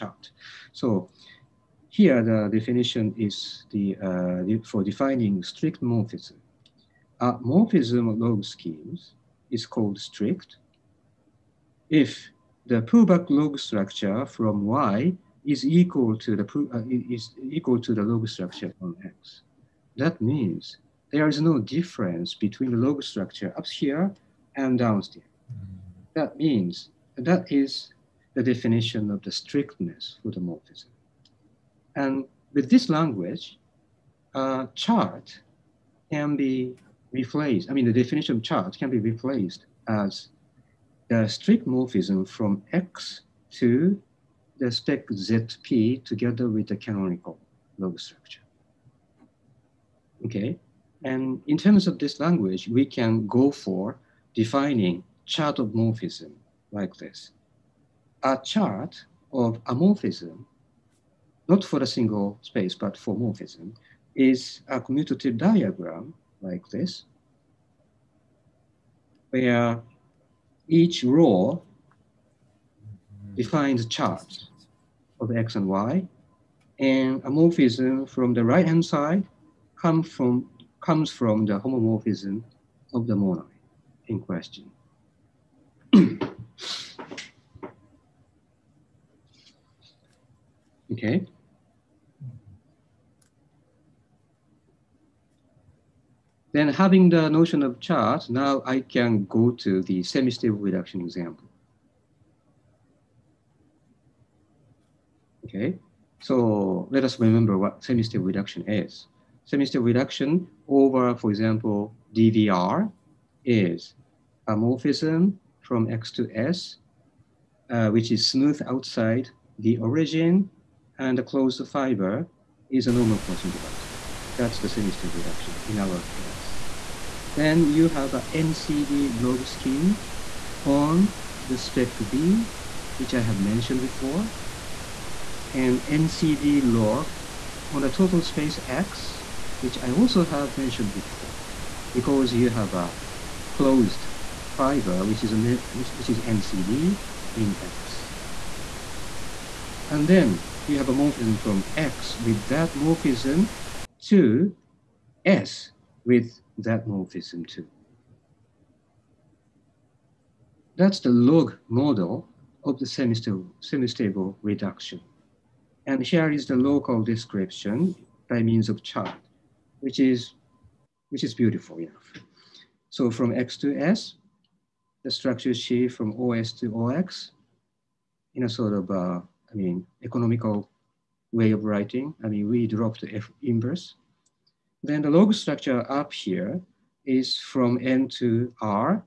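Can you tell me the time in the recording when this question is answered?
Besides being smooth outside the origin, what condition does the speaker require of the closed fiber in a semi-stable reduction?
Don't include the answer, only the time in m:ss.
2:02.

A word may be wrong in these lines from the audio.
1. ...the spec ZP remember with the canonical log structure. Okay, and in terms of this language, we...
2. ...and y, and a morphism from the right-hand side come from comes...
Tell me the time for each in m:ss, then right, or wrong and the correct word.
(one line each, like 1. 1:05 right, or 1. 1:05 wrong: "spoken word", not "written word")
1. 0:44 wrong: "together", not "remember"
2. 1:15 right.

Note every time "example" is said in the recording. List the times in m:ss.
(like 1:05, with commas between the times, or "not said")
1:41, 1:51.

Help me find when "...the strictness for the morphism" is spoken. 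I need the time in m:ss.
0:29.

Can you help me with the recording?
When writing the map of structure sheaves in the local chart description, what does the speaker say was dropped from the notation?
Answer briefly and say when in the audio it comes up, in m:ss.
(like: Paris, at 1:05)
F inverse, at 3:03.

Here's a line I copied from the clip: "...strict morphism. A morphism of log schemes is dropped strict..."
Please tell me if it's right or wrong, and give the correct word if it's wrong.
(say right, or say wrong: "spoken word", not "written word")
wrong: "called", not "dropped".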